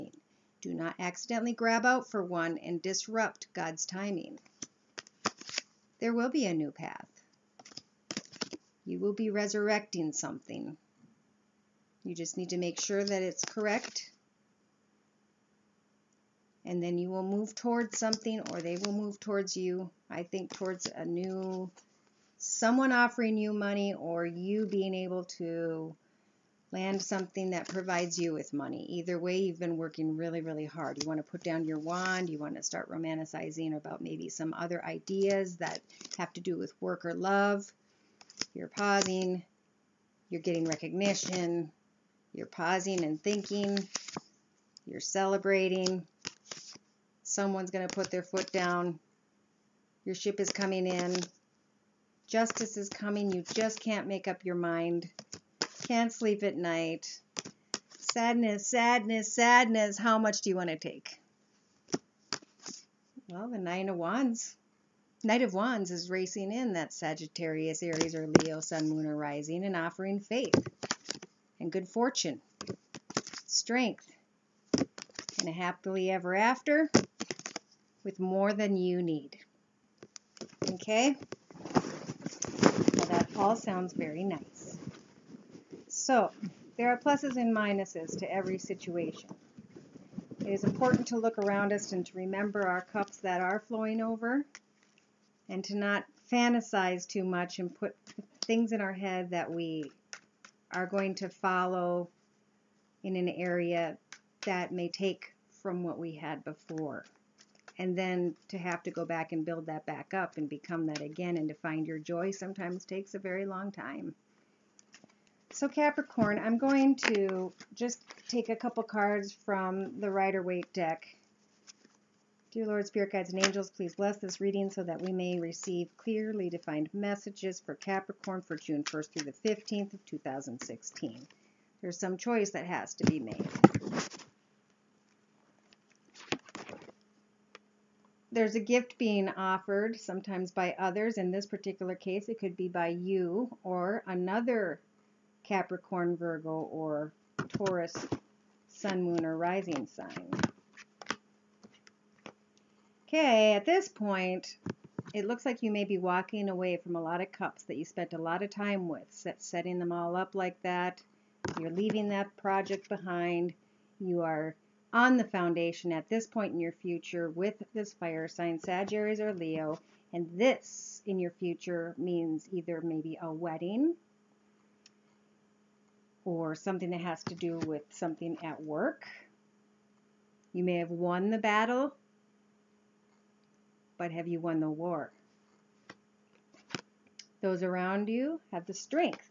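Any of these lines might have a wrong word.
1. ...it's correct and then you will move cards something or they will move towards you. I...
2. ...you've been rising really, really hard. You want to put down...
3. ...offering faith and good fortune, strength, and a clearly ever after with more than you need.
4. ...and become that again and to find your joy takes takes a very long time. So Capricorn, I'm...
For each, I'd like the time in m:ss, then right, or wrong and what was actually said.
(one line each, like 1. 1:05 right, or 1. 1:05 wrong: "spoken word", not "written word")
1. 0:13 wrong: "towards", not "cards"
2. 0:29 wrong: "working", not "rising"
3. 1:09 wrong: "happily", not "clearly"
4. 1:50 wrong: "sometimes", not "takes".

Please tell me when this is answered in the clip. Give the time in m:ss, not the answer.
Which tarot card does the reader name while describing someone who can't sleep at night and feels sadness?
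1:03.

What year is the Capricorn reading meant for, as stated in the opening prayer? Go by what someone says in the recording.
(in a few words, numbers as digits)
2016.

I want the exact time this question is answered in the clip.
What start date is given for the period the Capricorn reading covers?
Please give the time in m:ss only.
2:08.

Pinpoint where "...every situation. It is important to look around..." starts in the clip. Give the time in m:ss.
1:28.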